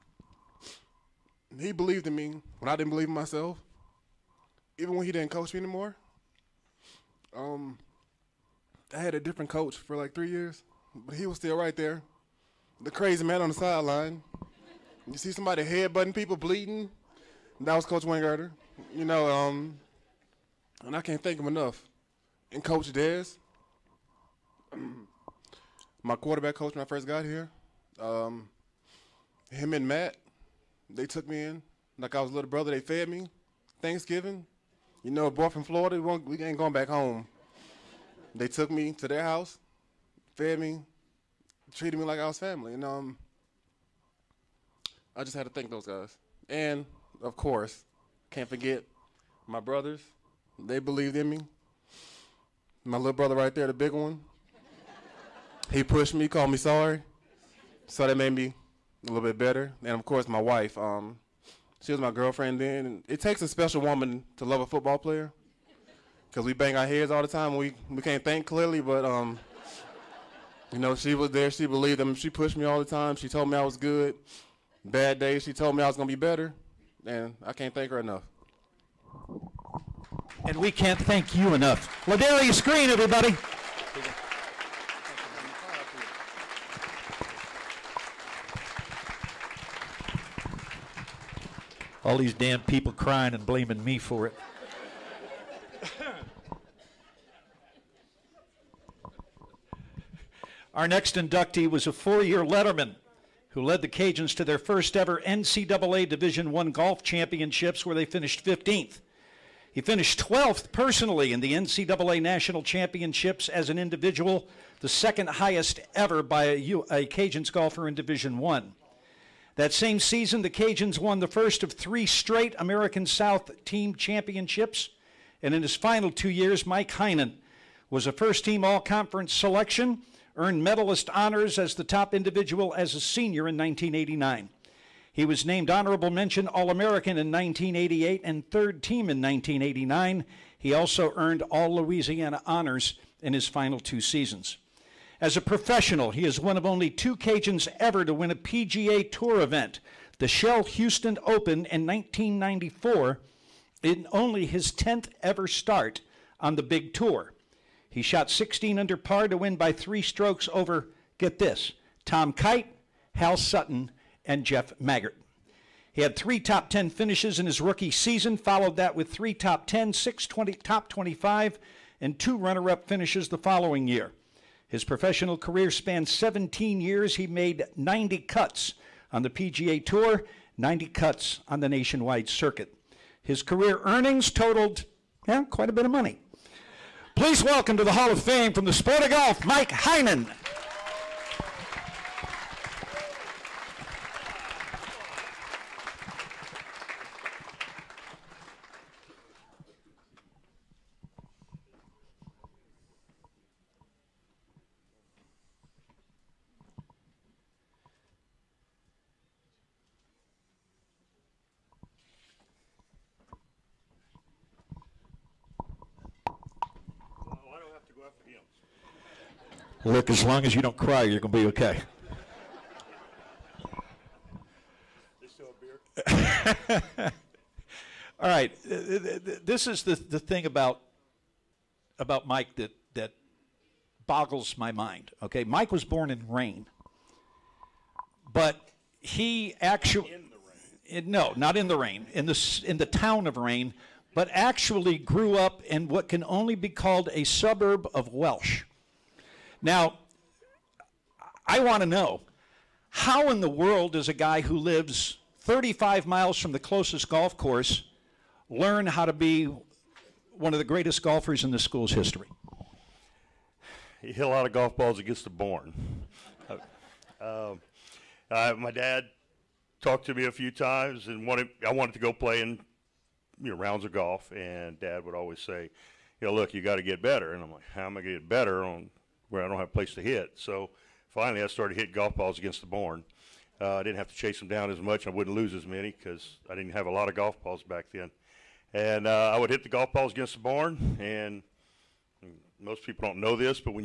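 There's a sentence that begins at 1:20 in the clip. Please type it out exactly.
And we can't thank you enough.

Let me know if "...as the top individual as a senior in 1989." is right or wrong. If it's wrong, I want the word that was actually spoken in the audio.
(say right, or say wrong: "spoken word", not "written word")
right.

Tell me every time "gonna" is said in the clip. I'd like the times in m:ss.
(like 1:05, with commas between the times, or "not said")
1:15.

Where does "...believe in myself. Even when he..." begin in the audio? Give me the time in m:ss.
0:02.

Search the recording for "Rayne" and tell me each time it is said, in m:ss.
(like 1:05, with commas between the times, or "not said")
3:56, 4:03.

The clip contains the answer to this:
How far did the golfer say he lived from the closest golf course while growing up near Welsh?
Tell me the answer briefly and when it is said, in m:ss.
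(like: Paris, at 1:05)
35 miles, at 4:15.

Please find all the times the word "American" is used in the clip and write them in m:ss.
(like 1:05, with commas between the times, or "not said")
2:02, 2:16.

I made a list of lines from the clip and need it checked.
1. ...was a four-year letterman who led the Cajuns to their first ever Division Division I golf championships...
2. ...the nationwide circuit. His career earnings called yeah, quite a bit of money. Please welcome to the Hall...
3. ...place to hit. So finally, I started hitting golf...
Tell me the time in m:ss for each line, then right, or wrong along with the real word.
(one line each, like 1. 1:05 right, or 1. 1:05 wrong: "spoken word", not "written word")
1. 1:41 wrong: "NCAA", not "Division"
2. 3:01 wrong: "totaled", not "called"
3. 4:39 right.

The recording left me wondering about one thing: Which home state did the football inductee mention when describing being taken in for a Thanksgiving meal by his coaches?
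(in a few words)
Florida.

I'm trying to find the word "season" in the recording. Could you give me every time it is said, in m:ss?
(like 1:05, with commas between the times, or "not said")
1:59, 2:24, 2:47.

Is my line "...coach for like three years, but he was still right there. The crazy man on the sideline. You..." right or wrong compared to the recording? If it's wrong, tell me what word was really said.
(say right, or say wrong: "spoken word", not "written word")
right.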